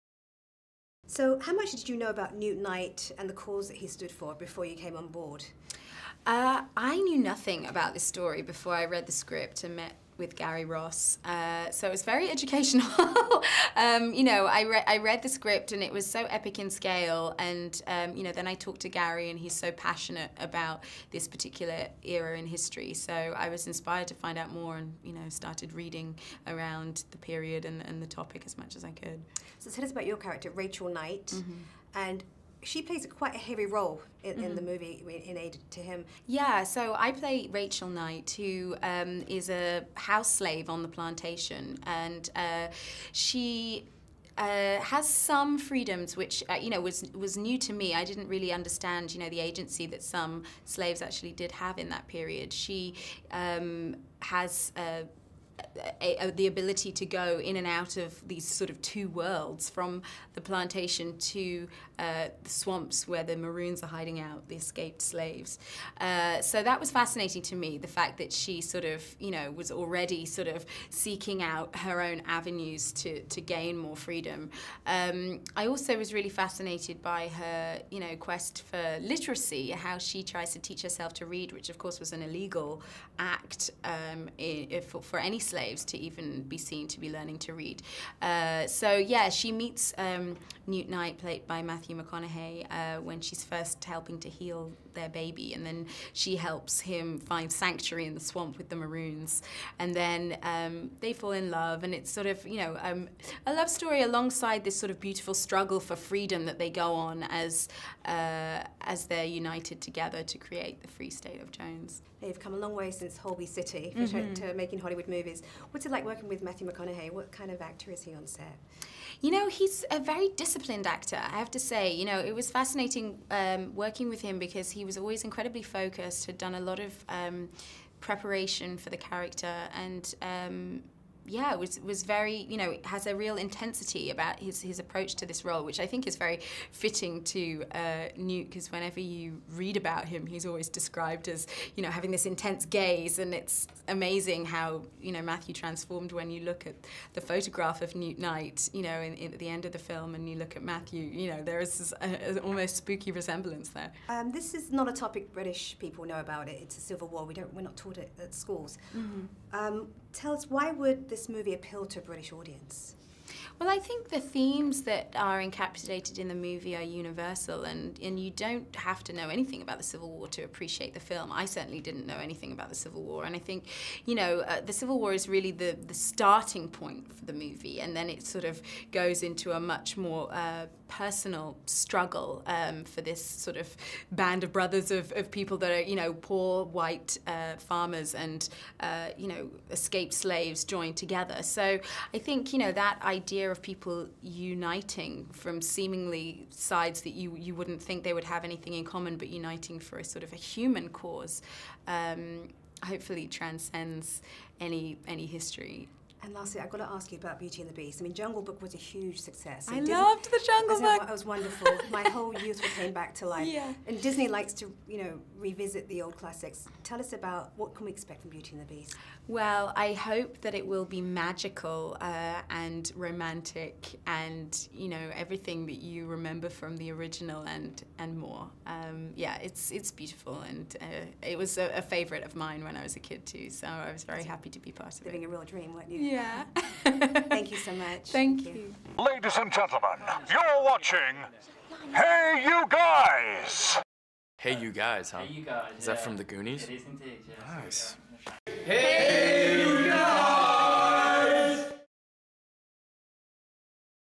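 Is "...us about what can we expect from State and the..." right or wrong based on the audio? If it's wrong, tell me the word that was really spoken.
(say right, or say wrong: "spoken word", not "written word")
wrong: "Beauty", not "State".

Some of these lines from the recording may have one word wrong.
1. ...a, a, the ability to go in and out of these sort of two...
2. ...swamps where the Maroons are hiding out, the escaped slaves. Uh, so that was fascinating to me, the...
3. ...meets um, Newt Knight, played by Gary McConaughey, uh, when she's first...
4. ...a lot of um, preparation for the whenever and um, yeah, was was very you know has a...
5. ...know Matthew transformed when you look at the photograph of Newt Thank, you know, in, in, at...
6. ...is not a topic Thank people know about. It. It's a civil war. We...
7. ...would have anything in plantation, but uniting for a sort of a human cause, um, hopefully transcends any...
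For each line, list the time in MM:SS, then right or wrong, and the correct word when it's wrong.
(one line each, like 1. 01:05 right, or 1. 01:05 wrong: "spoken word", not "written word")
1. 00:56 right
2. 01:02 right
3. 01:29 wrong: "Matthew", not "Gary"
4. 02:06 wrong: "character", not "whenever"
5. 02:25 wrong: "Knight", not "Thank"
6. 02:34 wrong: "British", not "Thank"
7. 03:18 wrong: "common", not "plantation".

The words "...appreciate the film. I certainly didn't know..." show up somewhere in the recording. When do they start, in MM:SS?
02:50.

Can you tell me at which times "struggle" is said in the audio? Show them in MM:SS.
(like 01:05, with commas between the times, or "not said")
01:45, 03:01.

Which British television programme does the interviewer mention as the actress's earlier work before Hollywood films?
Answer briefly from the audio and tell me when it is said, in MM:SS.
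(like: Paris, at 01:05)
Holby City, at 01:53.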